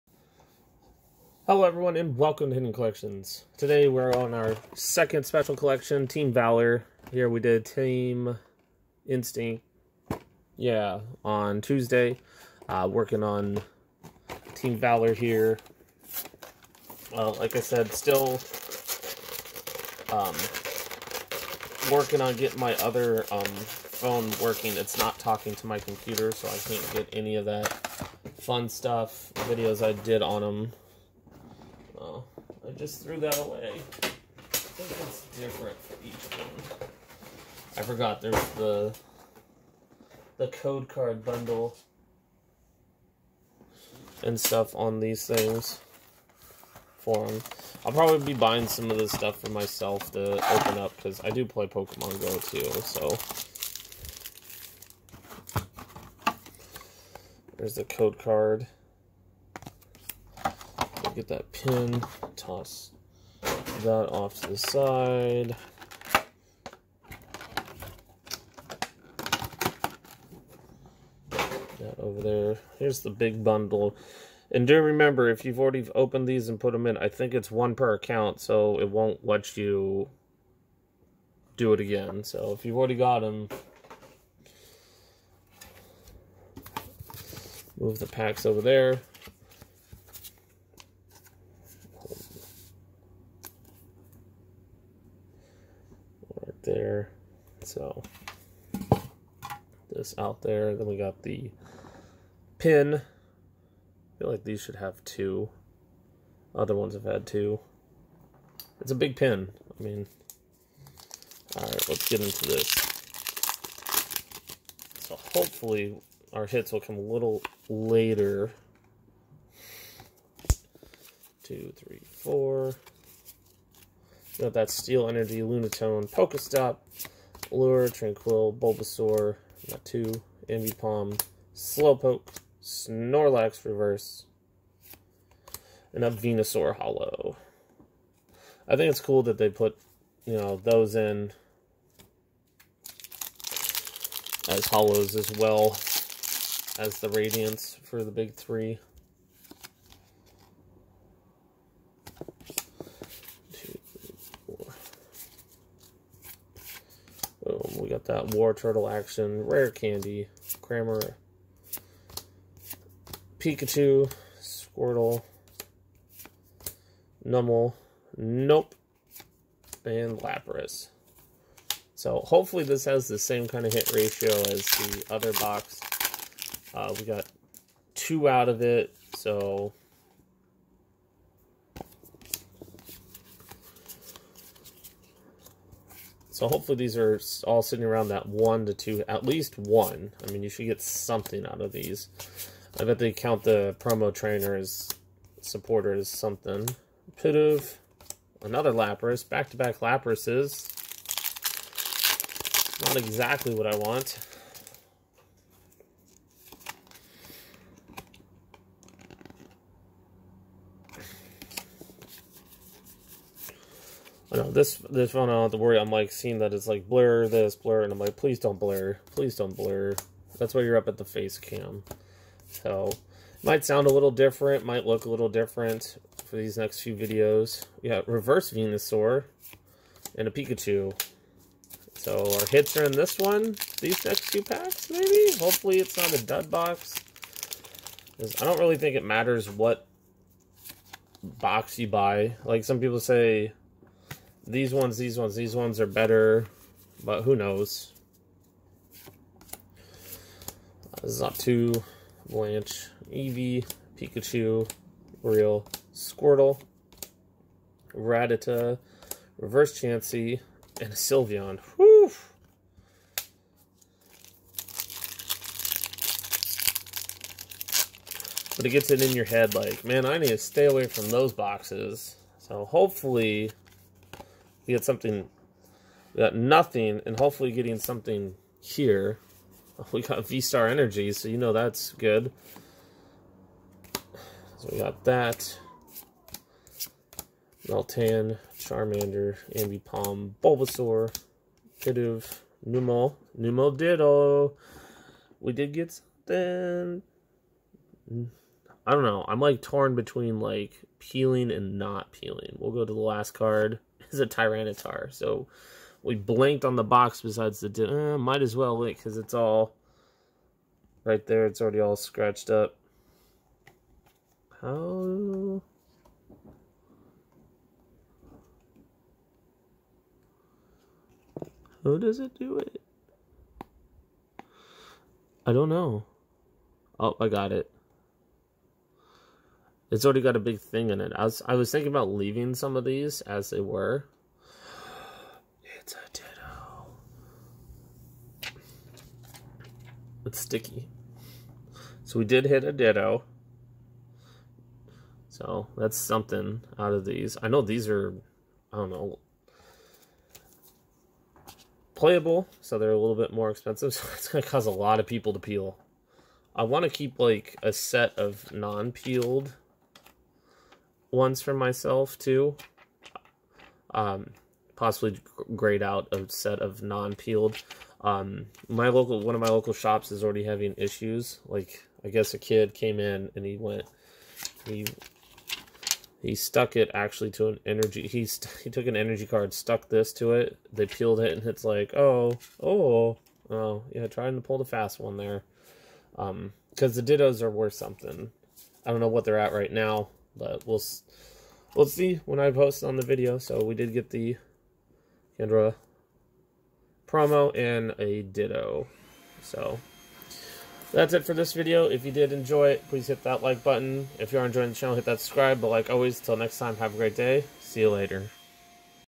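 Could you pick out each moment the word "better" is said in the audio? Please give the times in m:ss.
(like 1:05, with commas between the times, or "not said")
4:05.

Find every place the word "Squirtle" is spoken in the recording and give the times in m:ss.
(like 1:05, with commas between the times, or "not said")
2:44, 4:15.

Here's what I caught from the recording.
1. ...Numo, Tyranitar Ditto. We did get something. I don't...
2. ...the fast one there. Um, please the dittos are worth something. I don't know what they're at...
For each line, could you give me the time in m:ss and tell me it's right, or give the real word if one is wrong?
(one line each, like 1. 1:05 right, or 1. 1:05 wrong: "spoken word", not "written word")
1. 4:52 wrong: "Numo", not "Tyranitar"
2. 6:24 wrong: "cause", not "please".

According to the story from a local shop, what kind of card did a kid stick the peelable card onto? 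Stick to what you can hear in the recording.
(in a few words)
An energy card.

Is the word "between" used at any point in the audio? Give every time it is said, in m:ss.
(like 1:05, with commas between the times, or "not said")
4:59.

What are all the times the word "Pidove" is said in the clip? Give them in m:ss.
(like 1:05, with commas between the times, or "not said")
3:17, 4:51.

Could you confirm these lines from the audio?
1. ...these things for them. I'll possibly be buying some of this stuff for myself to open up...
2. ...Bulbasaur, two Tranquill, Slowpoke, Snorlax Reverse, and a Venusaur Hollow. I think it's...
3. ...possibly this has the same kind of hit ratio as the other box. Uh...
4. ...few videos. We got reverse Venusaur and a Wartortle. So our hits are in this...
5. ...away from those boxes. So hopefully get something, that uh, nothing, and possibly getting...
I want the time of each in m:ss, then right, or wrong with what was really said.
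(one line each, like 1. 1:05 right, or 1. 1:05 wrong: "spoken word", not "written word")
1. 0:44 wrong: "probably", not "possibly"
2. 2:08 wrong: "Ambipom", not "Tranquill"
3. 2:52 wrong: "hopefully", not "possibly"
4. 3:46 wrong: "Pikachu", not "Wartortle"
5. 4:30 wrong: "hopefully", not "possibly".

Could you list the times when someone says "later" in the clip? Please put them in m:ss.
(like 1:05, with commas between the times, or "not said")
1:57, 6:47.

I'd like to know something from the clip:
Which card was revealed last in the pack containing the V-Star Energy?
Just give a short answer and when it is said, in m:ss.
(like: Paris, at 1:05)
Tyranitar, at 5:04.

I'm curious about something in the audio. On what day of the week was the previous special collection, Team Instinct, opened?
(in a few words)
Tuesday.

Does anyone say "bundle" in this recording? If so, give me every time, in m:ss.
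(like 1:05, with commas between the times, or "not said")
0:41, 1:13.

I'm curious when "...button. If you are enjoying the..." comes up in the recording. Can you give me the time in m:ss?
6:43.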